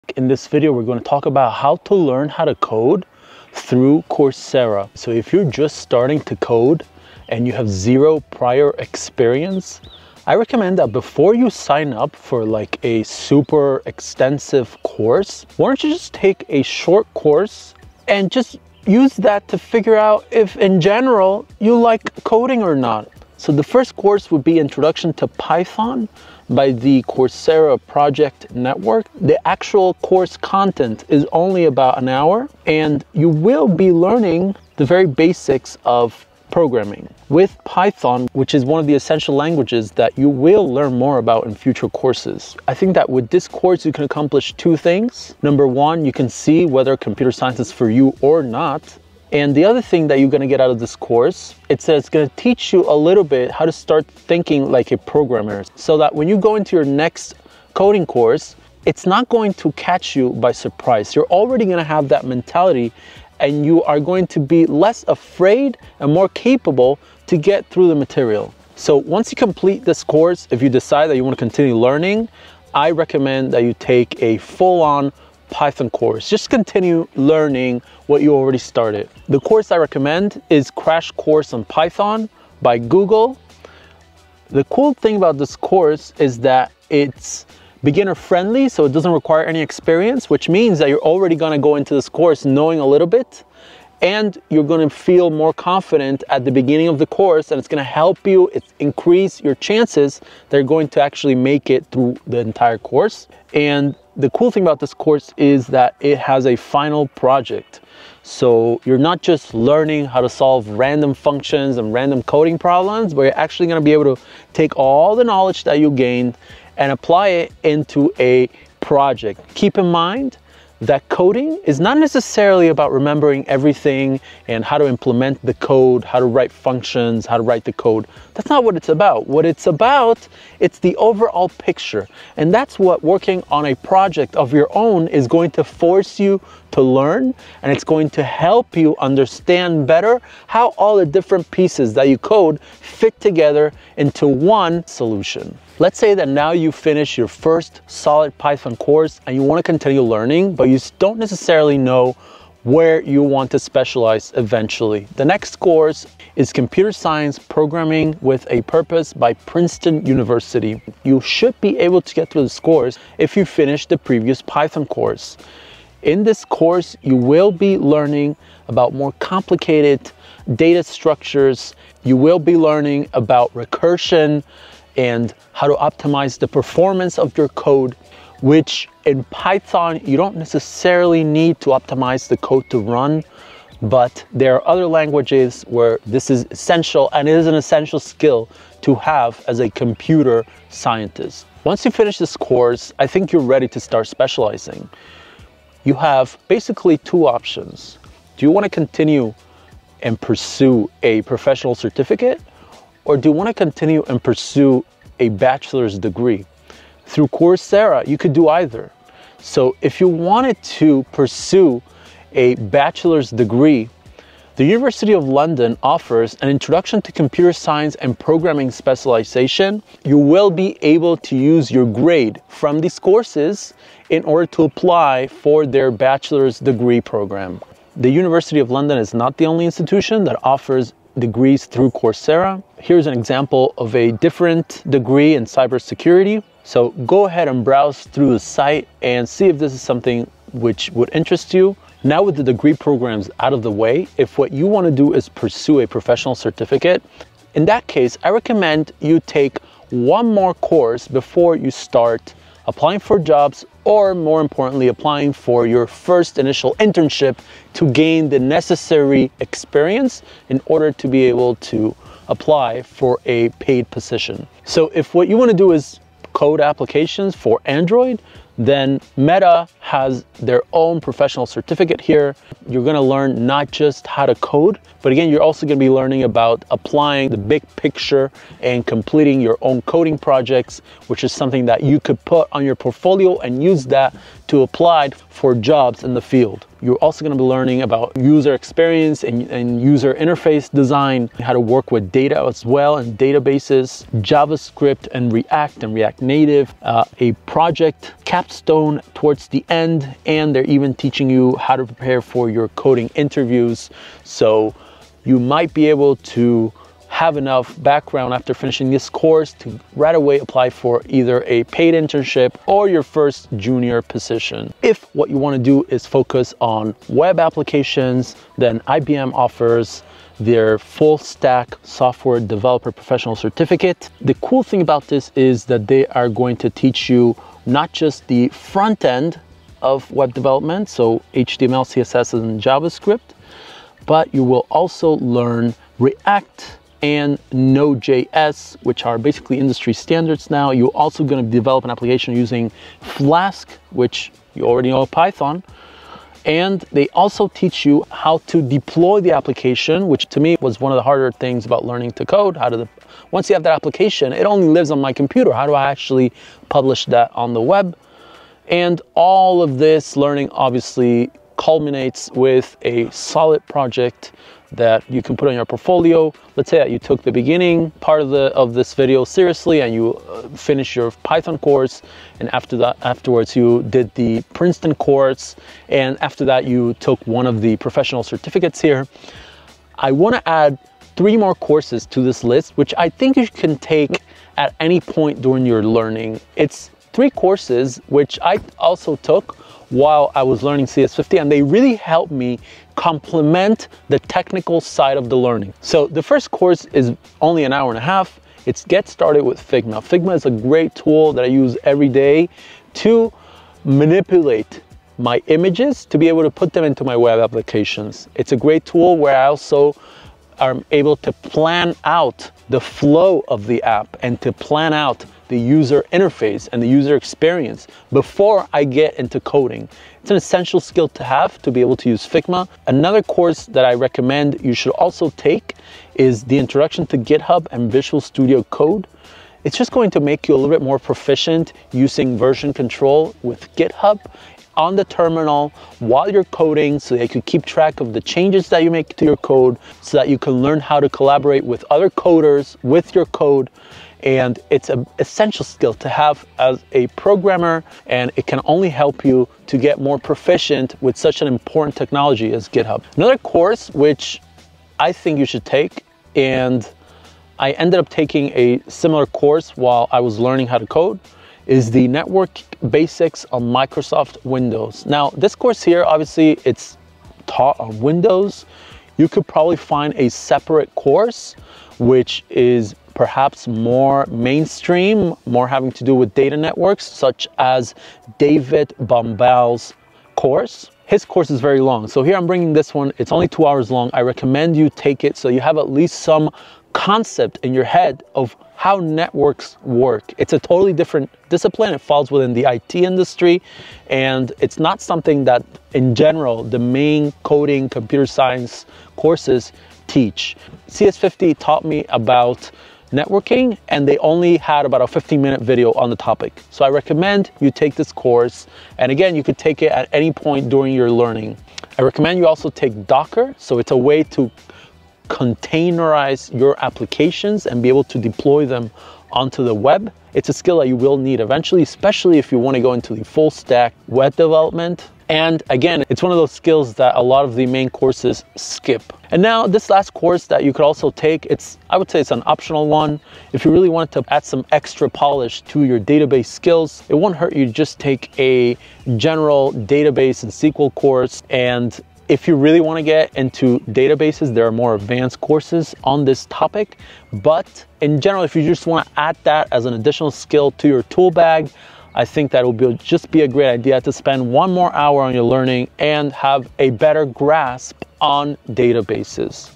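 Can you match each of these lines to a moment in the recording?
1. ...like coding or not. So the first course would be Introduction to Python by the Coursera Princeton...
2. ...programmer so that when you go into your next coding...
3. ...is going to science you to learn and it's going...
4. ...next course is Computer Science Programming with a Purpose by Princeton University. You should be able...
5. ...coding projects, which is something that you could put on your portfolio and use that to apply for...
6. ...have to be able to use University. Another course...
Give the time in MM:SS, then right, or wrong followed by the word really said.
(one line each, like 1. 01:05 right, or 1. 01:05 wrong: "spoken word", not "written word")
1. 00:21 wrong: "Project", not "Princeton"
2. 00:54 right
3. 02:15 wrong: "force", not "science"
4. 02:35 right
5. 04:39 right
6. 07:01 wrong: "Figma", not "University".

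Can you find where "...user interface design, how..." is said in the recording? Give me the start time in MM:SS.
04:49.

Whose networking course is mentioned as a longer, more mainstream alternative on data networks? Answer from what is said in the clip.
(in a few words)
David Bombal.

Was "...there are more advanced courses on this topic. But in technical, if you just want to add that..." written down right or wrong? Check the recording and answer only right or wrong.
wrong.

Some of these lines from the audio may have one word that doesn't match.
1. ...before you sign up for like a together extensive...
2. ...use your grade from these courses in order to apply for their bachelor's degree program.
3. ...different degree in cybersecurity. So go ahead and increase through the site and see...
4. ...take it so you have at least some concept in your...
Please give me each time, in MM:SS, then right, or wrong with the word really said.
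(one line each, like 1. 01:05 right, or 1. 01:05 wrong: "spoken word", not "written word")
1. 00:10 wrong: "super", not "together"
2. 03:41 right
3. 03:54 wrong: "browse", not "increase"
4. 08:04 right.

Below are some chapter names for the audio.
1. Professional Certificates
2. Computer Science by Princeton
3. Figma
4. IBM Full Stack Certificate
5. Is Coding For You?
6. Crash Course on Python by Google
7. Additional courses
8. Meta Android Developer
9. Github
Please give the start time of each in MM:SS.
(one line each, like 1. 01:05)
1. 04:01
2. 02:25
3. 06:36
4. 05:14
5. 00:23
6. 01:20
7. 06:05
8. 04:24
9. 07:02.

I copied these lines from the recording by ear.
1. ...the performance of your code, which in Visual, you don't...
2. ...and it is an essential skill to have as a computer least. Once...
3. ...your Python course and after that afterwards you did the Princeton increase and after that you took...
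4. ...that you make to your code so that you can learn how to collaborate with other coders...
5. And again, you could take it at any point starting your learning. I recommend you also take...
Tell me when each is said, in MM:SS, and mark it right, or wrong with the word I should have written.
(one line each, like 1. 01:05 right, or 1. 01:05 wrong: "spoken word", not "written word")
1. 02:56 wrong: "Python", not "Visual"
2. 03:07 wrong: "scientist", not "least"
3. 06:10 wrong: "course", not "increase"
4. 07:18 right
5. 08:28 wrong: "during", not "starting".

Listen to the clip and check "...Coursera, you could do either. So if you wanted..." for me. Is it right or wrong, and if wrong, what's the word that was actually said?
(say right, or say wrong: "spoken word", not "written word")
right.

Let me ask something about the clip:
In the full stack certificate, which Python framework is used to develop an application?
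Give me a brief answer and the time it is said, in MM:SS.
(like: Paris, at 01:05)
Flask, at 05:43.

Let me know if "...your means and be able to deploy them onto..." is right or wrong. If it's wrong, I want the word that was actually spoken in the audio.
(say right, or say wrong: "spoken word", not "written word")
wrong: "applications", not "means".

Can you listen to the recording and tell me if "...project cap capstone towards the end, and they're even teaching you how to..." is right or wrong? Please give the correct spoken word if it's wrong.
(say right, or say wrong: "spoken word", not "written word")
right.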